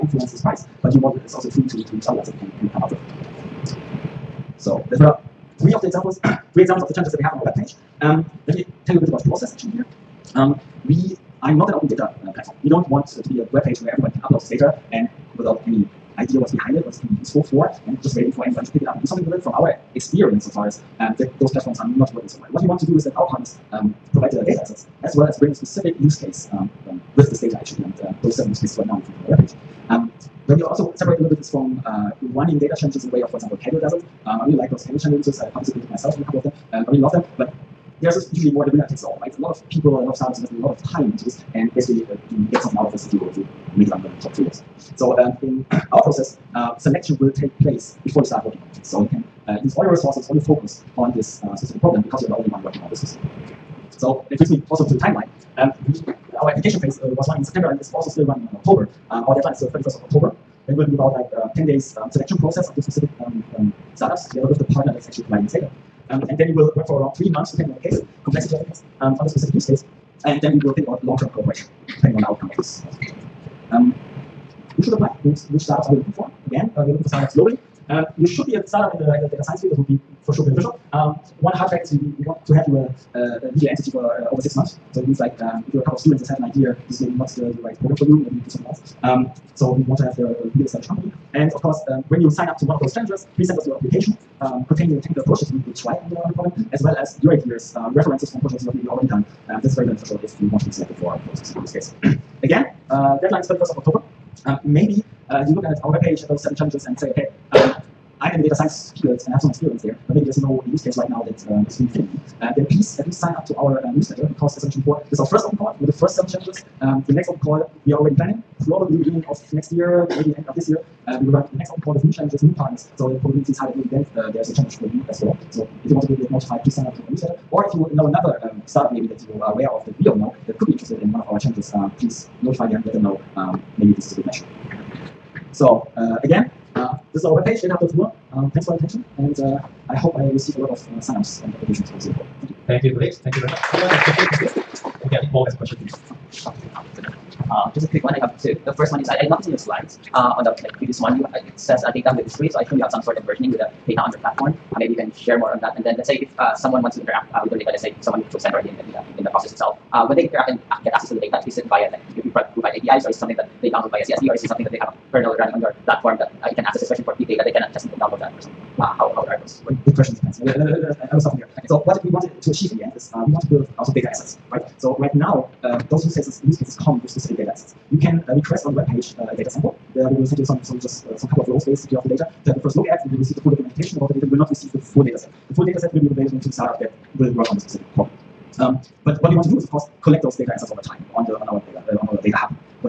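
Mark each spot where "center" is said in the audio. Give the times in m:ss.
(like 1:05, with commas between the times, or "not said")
2:38.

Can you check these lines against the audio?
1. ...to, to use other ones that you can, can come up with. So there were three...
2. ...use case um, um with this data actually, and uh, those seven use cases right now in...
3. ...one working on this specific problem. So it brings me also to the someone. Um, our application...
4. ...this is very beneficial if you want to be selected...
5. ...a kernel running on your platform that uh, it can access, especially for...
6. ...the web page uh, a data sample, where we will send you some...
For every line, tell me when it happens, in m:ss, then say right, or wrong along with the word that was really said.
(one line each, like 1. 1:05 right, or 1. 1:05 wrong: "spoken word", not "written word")
1. 0:01 right
2. 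0:25 right
3. 0:52 wrong: "timeline", not "someone"
4. 1:39 right
5. 2:44 right
6. 2:58 right.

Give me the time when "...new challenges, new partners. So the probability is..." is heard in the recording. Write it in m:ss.
2:02.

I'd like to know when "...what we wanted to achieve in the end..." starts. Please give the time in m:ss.
2:51.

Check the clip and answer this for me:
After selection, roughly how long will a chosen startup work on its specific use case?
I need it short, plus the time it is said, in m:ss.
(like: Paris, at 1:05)
3 months, at 1:07.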